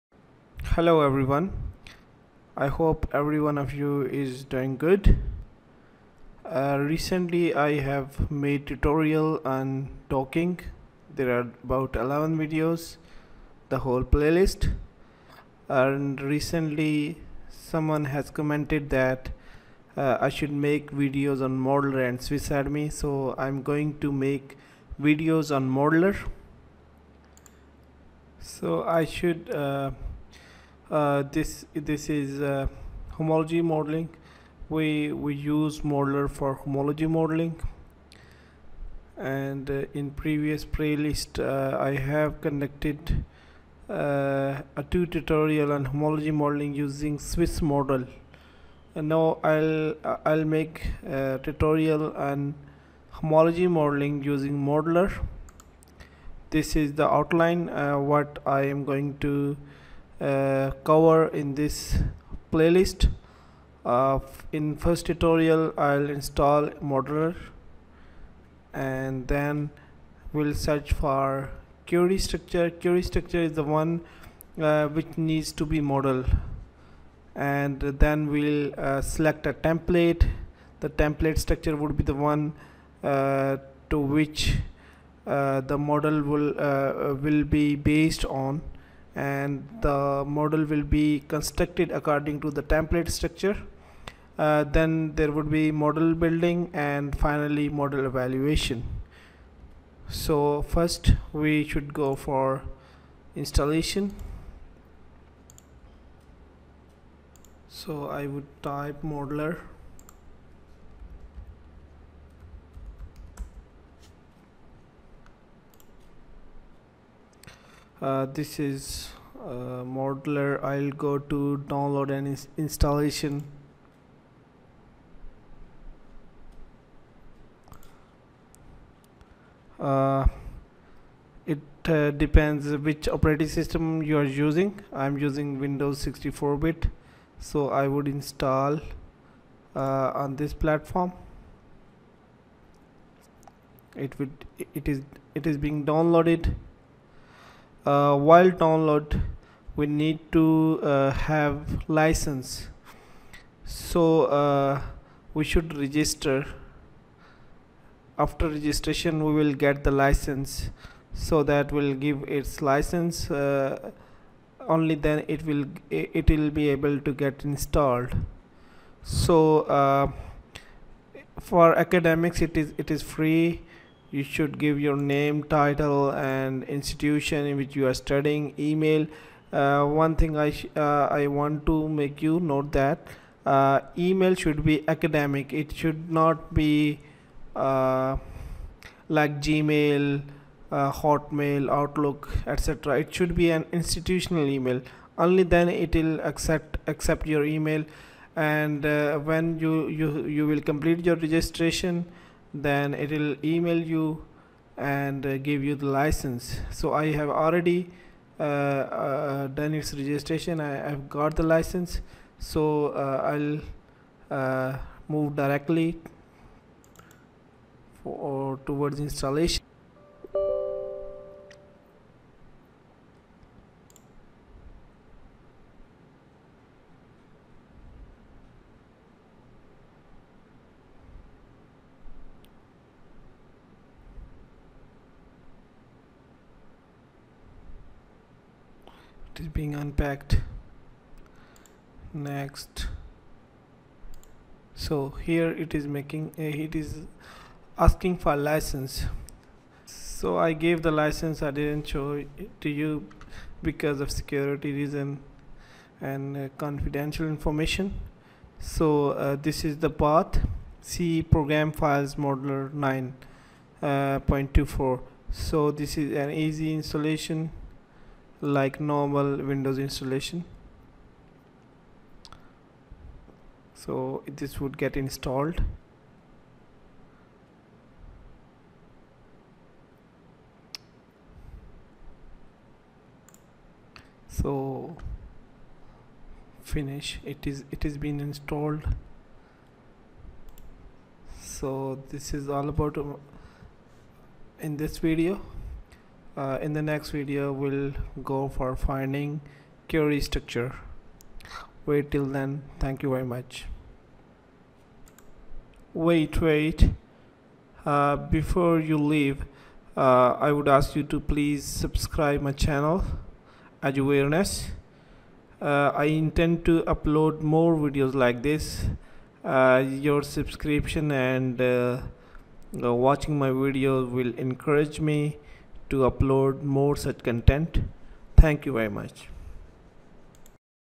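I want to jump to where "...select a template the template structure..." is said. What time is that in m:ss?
1:19.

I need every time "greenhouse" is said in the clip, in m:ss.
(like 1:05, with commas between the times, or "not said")
not said.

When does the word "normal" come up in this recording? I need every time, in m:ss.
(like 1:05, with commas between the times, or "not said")
4:28.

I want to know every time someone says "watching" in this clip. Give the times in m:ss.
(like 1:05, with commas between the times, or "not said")
5:23.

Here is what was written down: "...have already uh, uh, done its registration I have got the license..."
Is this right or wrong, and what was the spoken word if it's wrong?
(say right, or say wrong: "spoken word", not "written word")
right.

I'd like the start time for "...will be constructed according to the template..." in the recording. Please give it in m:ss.
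1:30.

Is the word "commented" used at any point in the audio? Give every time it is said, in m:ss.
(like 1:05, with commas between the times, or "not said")
0:18.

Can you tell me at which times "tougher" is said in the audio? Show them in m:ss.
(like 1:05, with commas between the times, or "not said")
not said.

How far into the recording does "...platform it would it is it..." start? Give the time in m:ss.
2:20.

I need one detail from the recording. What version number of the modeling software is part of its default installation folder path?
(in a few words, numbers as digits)
9.24.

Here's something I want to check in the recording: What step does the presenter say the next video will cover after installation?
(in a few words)
finding query structure.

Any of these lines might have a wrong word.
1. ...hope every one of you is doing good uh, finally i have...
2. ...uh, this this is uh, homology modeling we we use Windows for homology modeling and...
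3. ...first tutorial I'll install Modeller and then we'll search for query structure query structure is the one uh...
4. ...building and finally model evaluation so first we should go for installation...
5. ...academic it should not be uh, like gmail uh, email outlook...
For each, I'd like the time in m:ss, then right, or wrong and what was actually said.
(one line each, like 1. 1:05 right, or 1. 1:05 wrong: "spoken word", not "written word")
1. 0:02 wrong: "recently", not "finally"
2. 0:30 wrong: "Modeller", not "Windows"
3. 1:04 right
4. 1:36 right
5. 3:04 wrong: "hotmail", not "email".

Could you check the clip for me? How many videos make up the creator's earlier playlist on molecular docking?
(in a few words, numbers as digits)
11.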